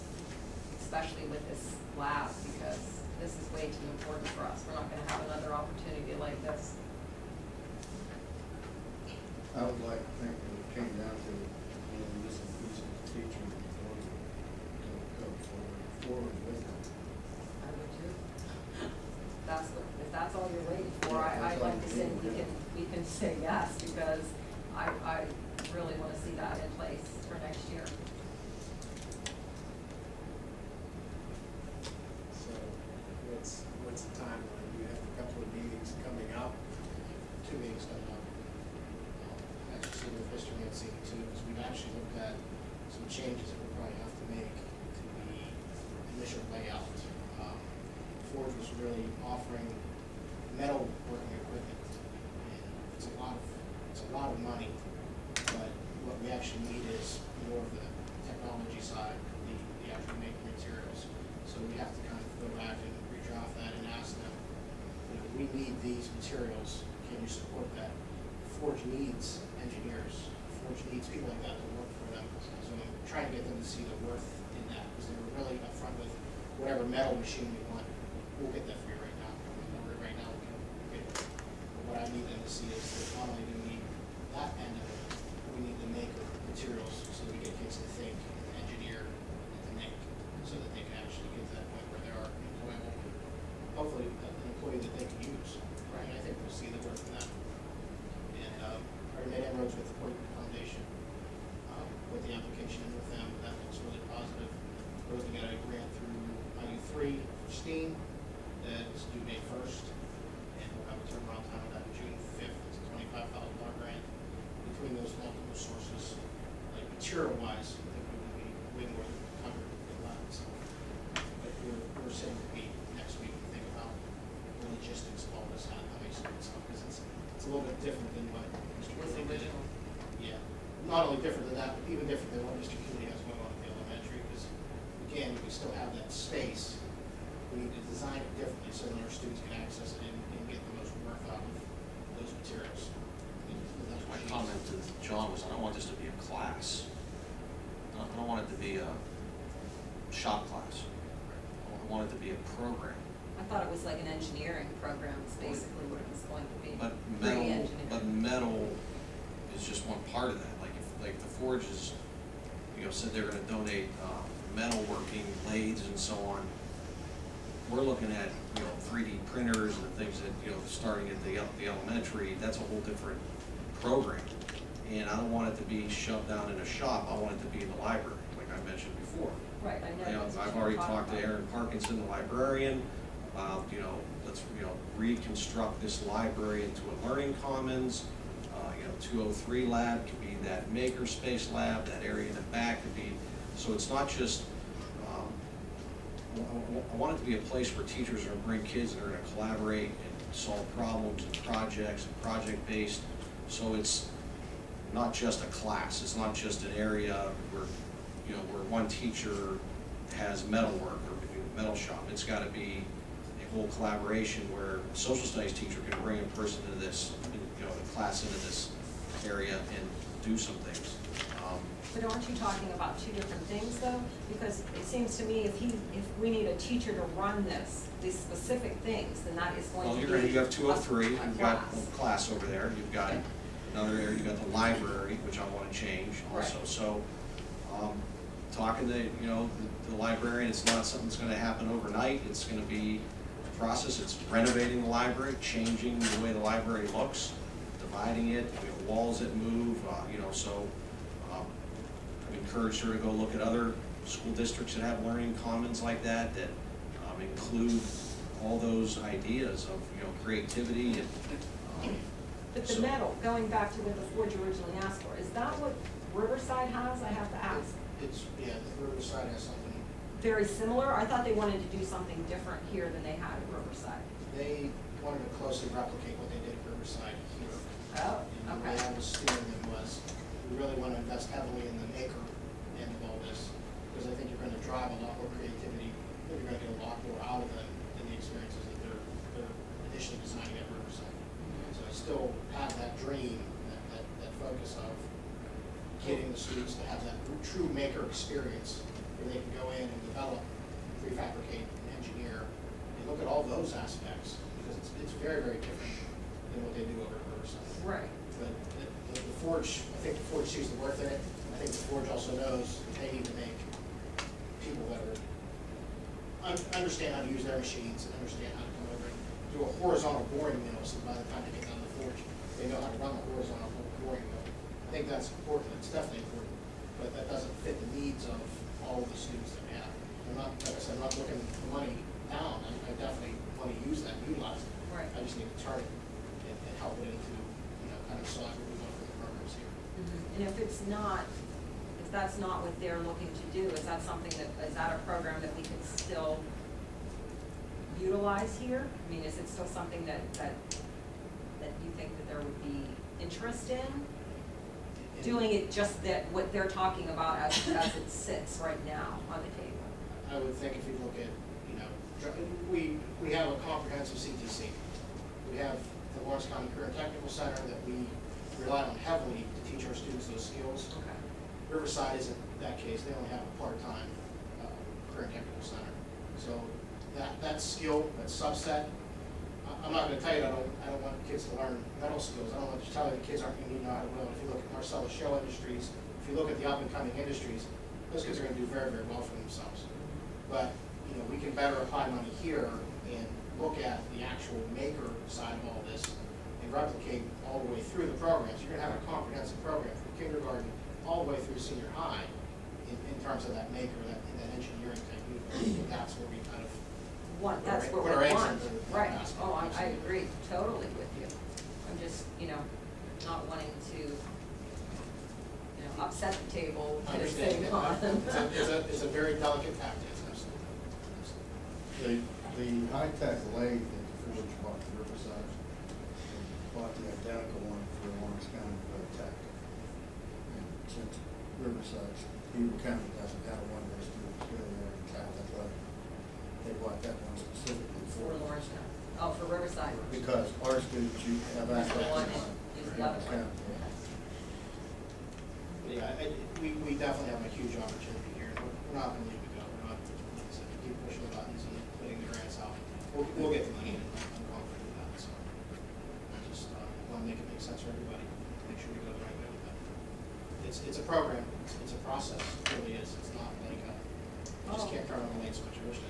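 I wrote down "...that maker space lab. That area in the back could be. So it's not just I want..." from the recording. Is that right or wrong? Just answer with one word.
right.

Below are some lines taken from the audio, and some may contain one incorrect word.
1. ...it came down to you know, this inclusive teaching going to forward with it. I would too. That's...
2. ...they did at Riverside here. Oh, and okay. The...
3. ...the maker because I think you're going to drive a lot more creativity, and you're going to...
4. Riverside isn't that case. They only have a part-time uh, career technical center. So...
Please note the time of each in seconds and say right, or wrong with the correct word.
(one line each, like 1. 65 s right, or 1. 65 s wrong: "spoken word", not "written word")
1. 10 s right
2. 276 s right
3. 281 s right
4. 371 s right.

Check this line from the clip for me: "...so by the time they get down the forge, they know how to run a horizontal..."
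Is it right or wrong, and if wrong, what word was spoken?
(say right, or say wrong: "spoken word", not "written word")
right.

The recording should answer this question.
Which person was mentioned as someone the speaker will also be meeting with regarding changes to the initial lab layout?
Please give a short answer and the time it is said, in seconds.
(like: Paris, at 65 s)
Mr. Mancini, at 40 s.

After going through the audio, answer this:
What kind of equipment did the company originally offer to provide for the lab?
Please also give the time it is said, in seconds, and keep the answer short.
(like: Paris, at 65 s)
metal working equipment, at 50 s.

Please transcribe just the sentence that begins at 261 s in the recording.
Um, but the so medal, going back to what the Forge originally asked for, is that what Riverside has?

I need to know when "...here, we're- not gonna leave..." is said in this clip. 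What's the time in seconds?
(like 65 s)
448 s.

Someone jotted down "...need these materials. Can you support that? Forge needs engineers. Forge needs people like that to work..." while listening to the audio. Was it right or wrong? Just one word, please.
right.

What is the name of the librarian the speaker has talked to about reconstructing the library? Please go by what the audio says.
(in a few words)
Aaron Parkinson.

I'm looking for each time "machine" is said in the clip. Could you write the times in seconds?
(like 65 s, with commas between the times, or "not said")
77 s, 317 s.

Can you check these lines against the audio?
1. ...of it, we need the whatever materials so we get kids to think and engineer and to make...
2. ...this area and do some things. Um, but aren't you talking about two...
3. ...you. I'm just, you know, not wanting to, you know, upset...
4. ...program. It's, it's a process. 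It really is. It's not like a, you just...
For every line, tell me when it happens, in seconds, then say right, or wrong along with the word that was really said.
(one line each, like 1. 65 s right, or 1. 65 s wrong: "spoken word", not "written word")
1. 84 s wrong: "maker", not "whatever"
2. 218 s right
3. 411 s right
4. 461 s right.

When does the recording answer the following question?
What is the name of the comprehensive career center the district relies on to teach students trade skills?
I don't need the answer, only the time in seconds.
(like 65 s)
366 s.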